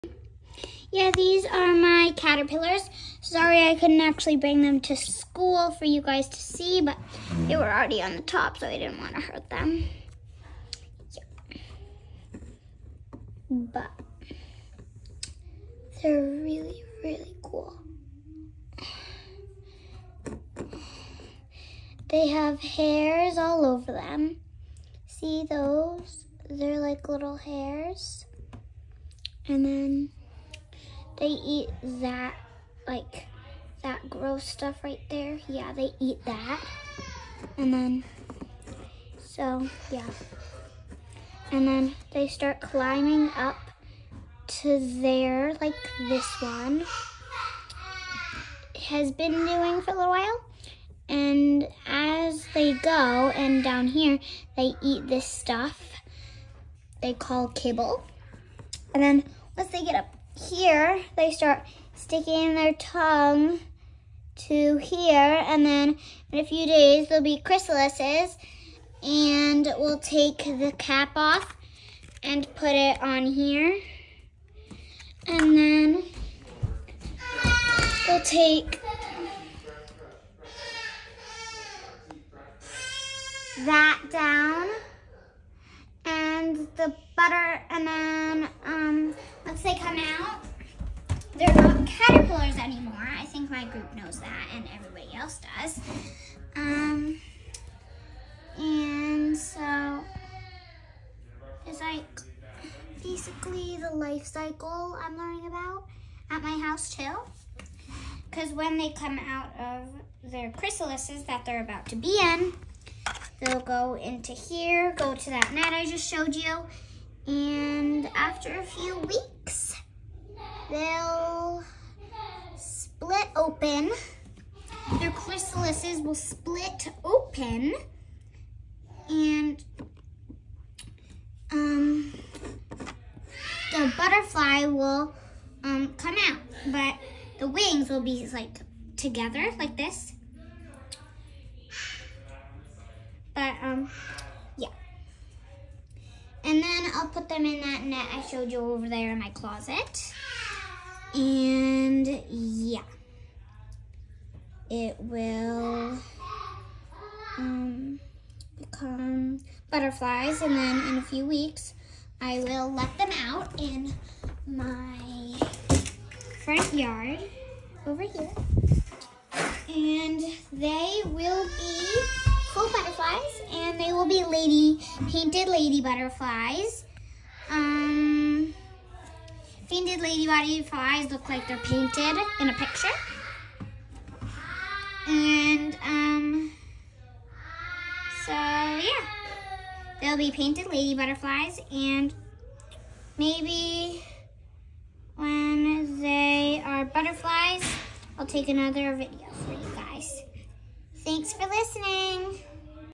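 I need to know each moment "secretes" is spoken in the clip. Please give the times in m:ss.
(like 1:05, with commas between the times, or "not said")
not said.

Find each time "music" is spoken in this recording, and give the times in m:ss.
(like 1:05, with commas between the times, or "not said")
not said.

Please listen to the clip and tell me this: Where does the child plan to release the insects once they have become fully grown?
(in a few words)
front yard.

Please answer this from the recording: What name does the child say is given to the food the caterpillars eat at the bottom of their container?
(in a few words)
kibble.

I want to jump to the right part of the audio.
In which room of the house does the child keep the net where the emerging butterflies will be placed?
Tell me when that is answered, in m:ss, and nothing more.
2:29.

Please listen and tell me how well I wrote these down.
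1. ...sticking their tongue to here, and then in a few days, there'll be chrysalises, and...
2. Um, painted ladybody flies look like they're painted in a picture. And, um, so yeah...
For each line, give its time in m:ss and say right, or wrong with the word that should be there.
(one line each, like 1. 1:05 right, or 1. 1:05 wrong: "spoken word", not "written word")
1. 1:01 right
2. 2:57 right.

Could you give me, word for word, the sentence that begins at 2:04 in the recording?
Their chrysalises will split open and um, the butterfly will um, come out, but the wings will be like together like this.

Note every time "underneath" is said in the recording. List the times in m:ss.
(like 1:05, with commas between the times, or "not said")
not said.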